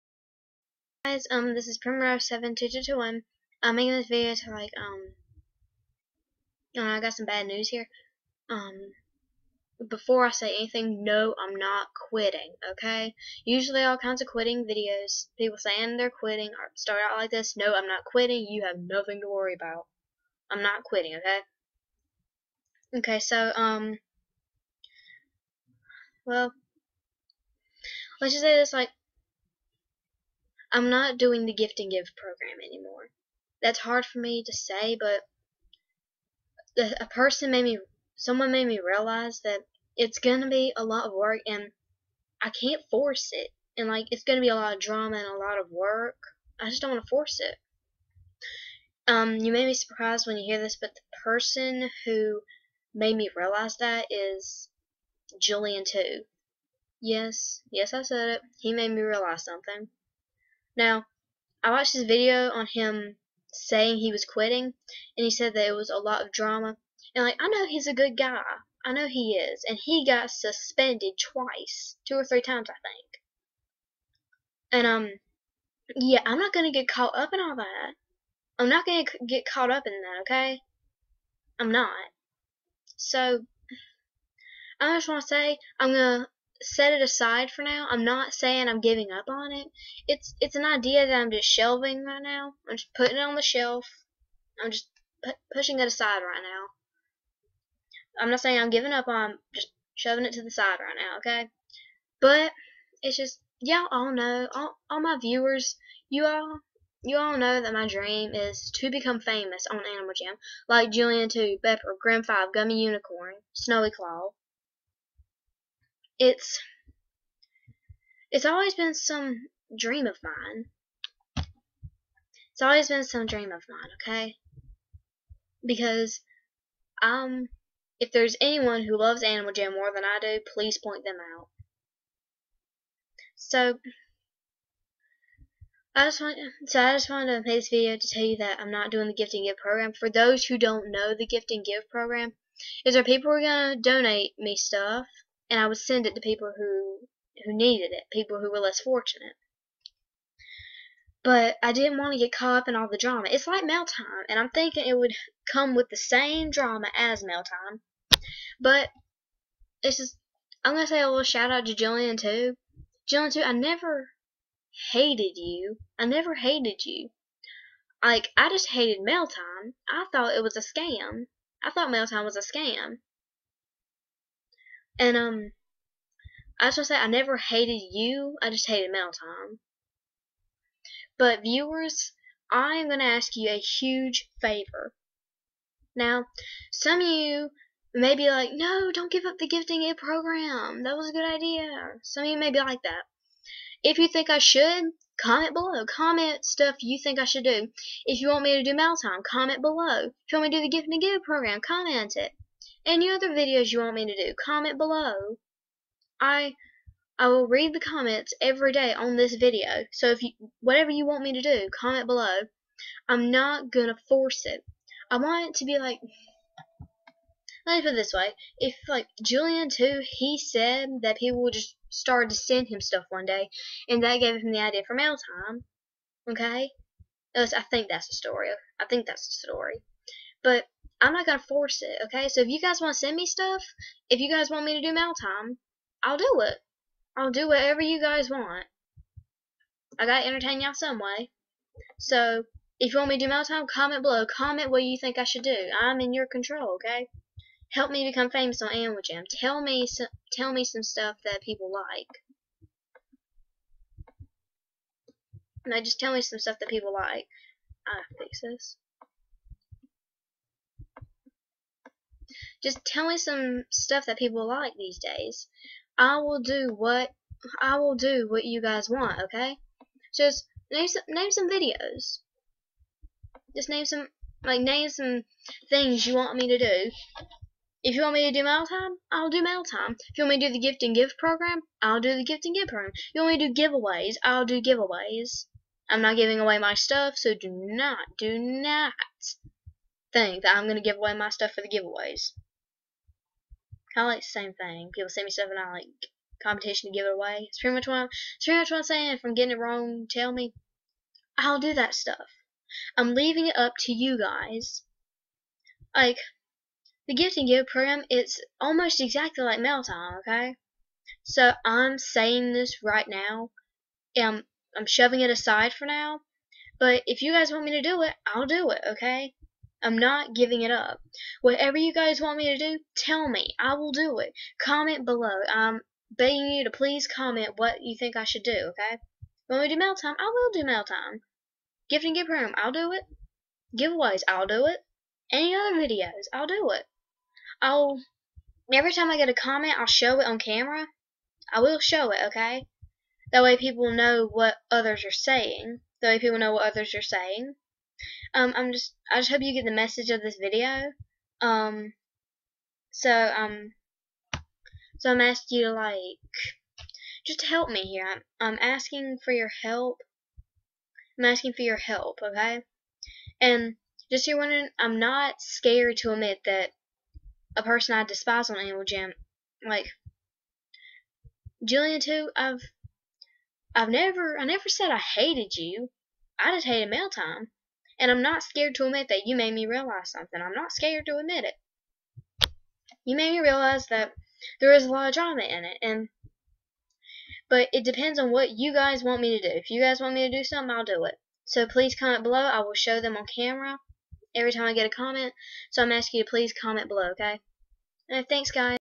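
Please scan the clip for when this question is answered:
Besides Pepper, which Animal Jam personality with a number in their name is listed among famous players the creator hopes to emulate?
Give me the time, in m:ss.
1:51.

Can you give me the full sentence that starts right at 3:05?
Now, some of you may be like, no, don't give up the gifting aid program.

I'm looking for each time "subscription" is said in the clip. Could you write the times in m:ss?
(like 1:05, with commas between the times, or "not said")
not said.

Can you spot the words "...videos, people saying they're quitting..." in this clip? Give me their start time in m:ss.
0:14.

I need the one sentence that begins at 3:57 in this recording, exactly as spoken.
I'll do whatever you guys want.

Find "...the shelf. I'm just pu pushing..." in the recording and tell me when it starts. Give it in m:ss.
1:33.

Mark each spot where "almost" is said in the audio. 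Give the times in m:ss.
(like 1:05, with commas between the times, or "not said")
5:08.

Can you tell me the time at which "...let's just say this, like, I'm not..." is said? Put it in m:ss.
0:28.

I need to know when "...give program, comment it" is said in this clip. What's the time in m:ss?
3:21.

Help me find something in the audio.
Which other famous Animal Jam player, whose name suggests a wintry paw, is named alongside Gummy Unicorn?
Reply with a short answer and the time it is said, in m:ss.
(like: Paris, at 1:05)
Snowy Claw, at 1:53.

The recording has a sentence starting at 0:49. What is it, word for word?
Um, you may be surprised when you hear this, but the person who made me realize that is Julian too.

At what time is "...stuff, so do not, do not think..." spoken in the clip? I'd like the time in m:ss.
4:46.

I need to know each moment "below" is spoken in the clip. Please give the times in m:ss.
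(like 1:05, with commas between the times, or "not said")
3:15, 3:19, 3:24, 3:32, 4:04, 5:25, 6:32, 6:36.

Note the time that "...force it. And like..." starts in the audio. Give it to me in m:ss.
0:42.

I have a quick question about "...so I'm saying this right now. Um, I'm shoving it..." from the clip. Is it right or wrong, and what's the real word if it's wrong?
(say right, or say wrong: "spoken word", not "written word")
right.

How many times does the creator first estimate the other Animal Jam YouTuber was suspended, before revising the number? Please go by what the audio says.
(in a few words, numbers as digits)
2.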